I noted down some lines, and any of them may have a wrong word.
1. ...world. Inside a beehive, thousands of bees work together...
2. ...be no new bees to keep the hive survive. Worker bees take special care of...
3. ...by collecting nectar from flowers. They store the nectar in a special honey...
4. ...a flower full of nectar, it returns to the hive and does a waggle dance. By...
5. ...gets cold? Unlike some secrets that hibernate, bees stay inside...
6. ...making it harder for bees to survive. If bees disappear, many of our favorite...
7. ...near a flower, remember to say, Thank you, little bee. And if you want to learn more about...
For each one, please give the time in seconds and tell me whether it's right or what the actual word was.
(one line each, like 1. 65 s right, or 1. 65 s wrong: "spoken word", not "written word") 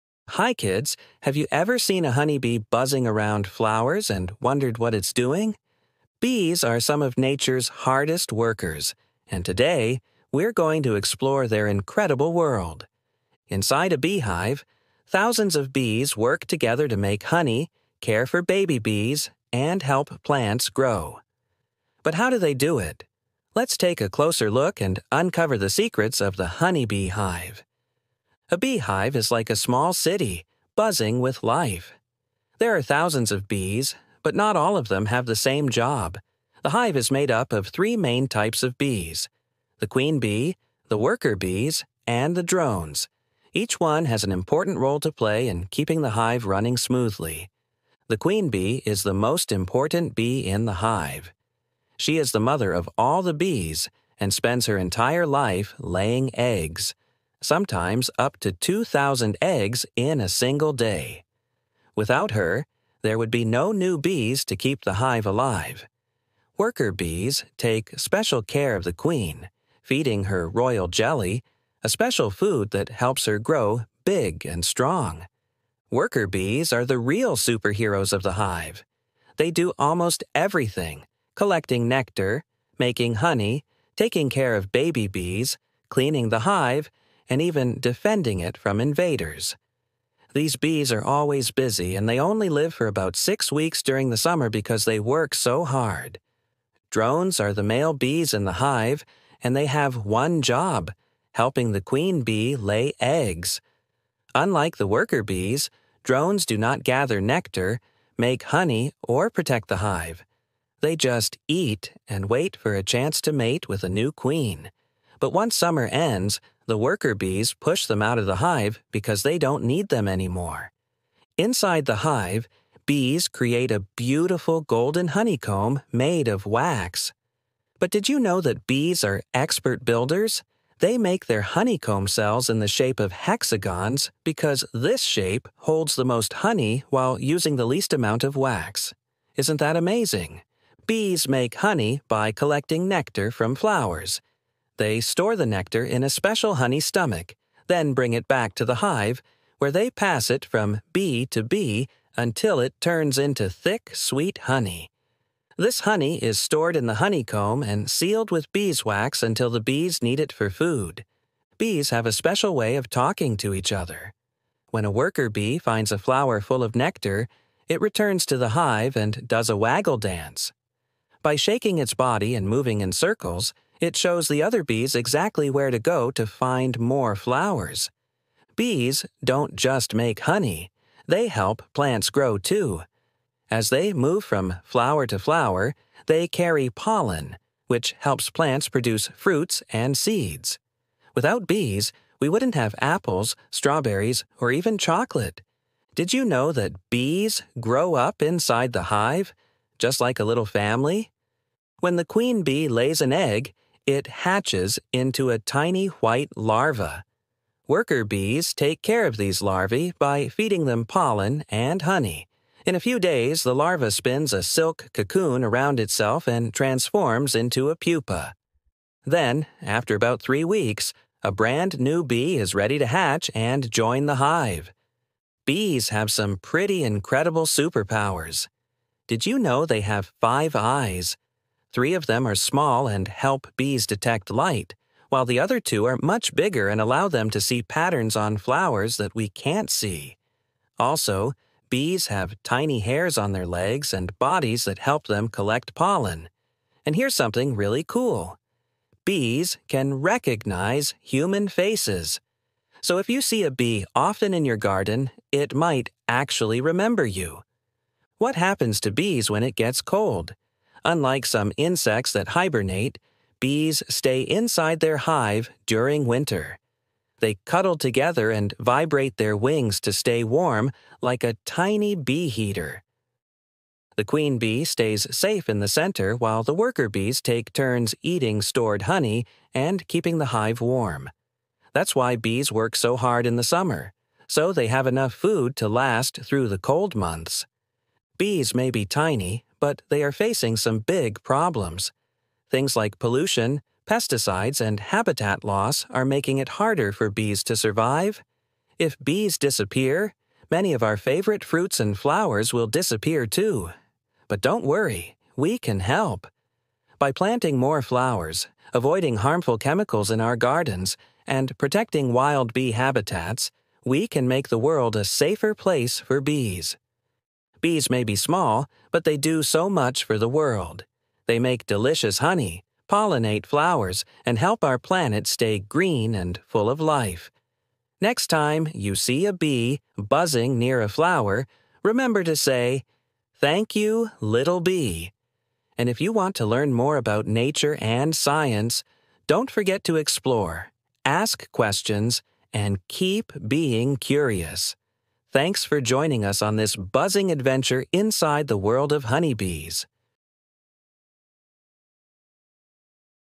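1. 12 s right
2. 63 s wrong: "alive", not "survive"
3. 142 s right
4. 165 s right
5. 259 s wrong: "insects", not "secrets"
6. 296 s right
7. 330 s right.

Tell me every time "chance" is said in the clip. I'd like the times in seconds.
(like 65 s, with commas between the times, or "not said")
112 s.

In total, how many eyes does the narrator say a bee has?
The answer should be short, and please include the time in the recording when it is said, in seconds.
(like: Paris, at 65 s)
5, at 230 s.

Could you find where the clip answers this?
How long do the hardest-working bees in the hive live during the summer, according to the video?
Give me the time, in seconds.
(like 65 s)
92 s.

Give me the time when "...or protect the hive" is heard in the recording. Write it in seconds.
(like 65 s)
109 s.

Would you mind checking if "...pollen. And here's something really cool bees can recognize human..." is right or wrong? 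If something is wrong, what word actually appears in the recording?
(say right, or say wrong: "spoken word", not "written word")
right.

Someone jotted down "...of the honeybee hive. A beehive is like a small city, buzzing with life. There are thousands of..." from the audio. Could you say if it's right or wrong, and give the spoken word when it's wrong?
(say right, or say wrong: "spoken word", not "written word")
right.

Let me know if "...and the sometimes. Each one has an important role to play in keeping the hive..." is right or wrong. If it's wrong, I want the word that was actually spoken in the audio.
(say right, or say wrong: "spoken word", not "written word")
wrong: "drones", not "sometimes".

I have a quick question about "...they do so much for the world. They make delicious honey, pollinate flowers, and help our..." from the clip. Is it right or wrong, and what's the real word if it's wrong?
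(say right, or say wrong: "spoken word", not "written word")
right.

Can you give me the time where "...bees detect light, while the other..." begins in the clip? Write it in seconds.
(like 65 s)
233 s.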